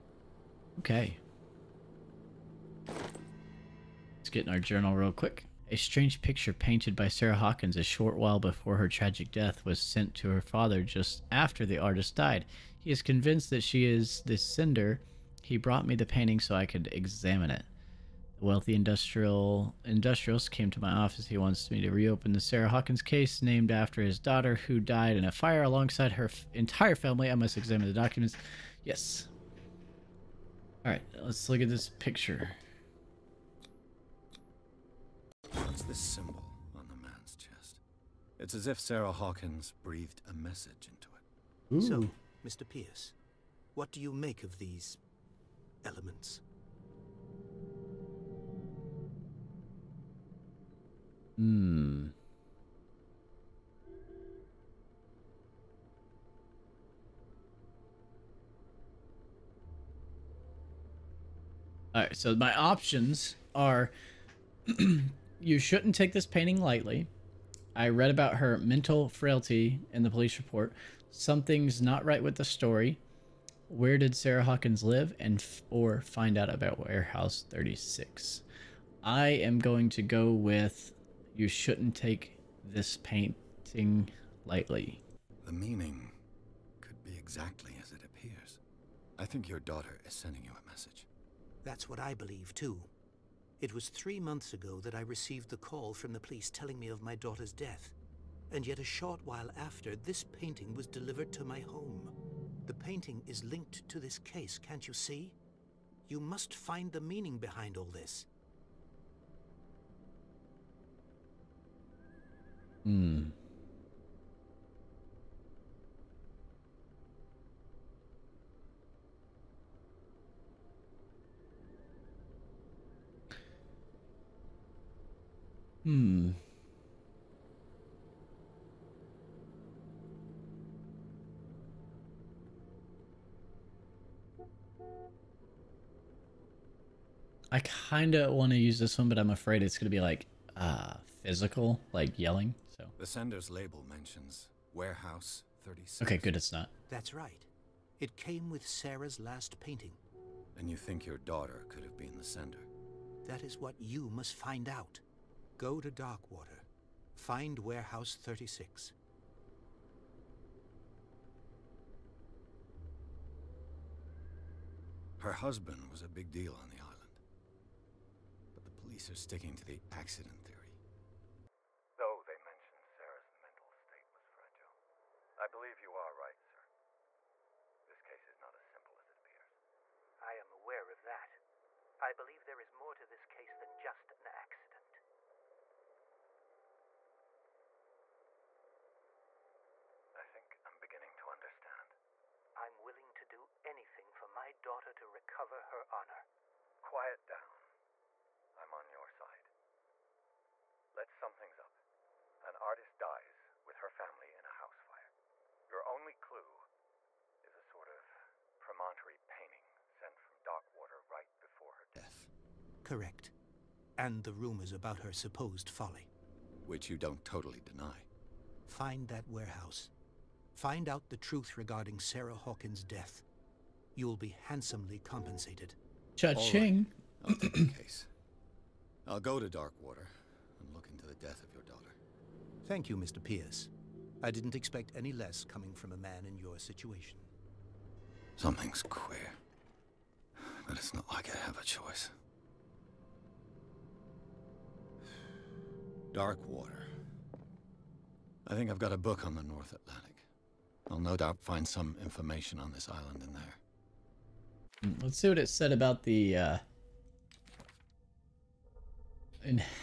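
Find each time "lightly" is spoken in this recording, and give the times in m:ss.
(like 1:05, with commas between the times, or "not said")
1:06, 1:24.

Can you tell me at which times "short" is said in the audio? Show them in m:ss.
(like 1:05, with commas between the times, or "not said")
0:07, 1:38.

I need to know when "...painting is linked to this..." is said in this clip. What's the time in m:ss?
1:42.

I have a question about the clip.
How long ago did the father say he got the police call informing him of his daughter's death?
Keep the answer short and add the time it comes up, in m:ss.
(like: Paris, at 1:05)
Three months, at 1:33.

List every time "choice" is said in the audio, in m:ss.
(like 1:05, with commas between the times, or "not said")
4:01.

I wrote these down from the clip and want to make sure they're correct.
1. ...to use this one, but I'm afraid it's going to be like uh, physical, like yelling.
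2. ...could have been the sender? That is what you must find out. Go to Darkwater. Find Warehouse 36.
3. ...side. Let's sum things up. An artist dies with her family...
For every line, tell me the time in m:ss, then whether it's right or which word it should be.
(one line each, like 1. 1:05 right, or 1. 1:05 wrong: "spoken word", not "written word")
1. 2:18 right
2. 2:31 right
3. 3:19 right.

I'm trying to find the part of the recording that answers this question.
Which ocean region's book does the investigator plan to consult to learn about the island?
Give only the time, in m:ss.
4:09.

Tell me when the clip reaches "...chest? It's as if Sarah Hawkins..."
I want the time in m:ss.
0:37.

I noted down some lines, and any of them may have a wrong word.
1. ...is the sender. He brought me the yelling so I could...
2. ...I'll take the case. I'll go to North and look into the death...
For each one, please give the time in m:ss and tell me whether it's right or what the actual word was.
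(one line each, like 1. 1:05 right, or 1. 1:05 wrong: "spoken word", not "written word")
1. 0:13 wrong: "painting", not "yelling"
2. 3:47 wrong: "Darkwater", not "North".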